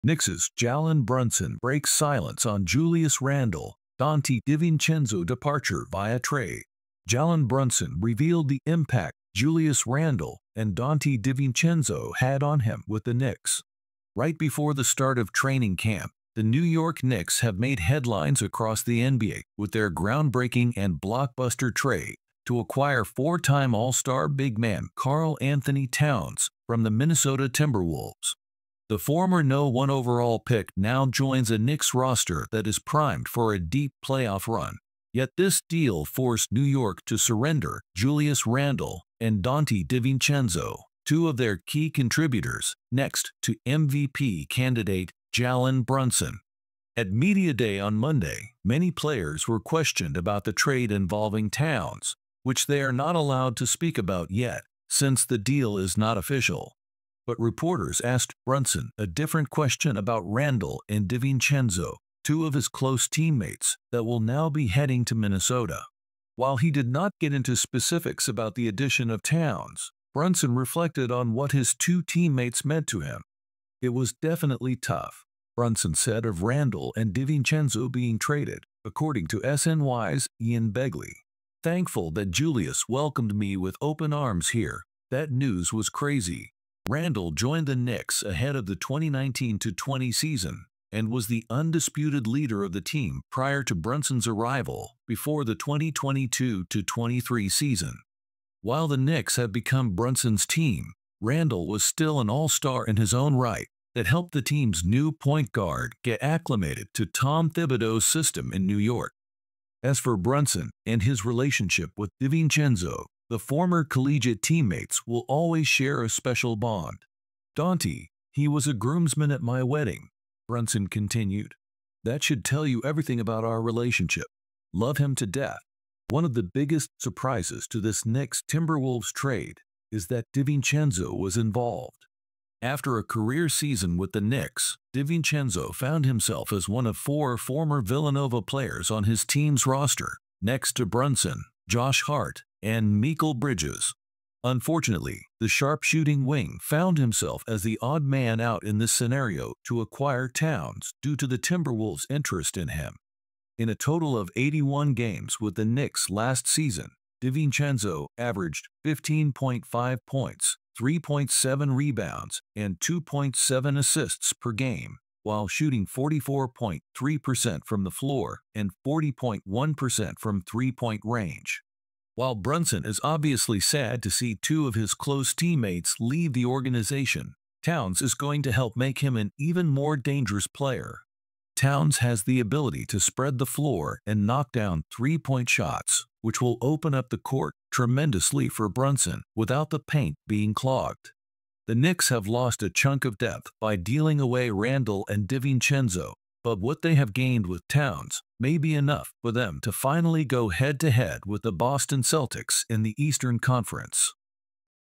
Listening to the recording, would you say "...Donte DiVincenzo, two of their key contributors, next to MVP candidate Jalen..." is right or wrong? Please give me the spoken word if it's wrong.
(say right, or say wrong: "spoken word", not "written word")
right.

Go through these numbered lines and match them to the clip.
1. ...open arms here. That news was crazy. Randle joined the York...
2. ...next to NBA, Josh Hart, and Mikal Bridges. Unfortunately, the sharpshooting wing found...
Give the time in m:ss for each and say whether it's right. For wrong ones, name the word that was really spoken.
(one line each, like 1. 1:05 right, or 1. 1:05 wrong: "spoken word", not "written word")
1. 1:23 wrong: "Knicks", not "York"
2. 2:20 wrong: "Brunson", not "NBA".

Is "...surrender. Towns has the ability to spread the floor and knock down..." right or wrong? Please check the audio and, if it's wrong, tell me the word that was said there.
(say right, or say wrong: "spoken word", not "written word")
wrong: "player", not "surrender".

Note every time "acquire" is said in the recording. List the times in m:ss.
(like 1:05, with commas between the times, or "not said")
0:22, 2:29.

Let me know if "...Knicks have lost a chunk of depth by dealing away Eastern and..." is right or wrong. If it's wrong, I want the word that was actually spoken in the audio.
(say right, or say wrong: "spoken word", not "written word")
wrong: "Randle", not "Eastern".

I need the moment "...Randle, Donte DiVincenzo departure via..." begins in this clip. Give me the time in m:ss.
0:03.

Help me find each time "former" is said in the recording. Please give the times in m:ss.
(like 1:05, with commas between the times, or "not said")
0:28, 1:53, 2:17.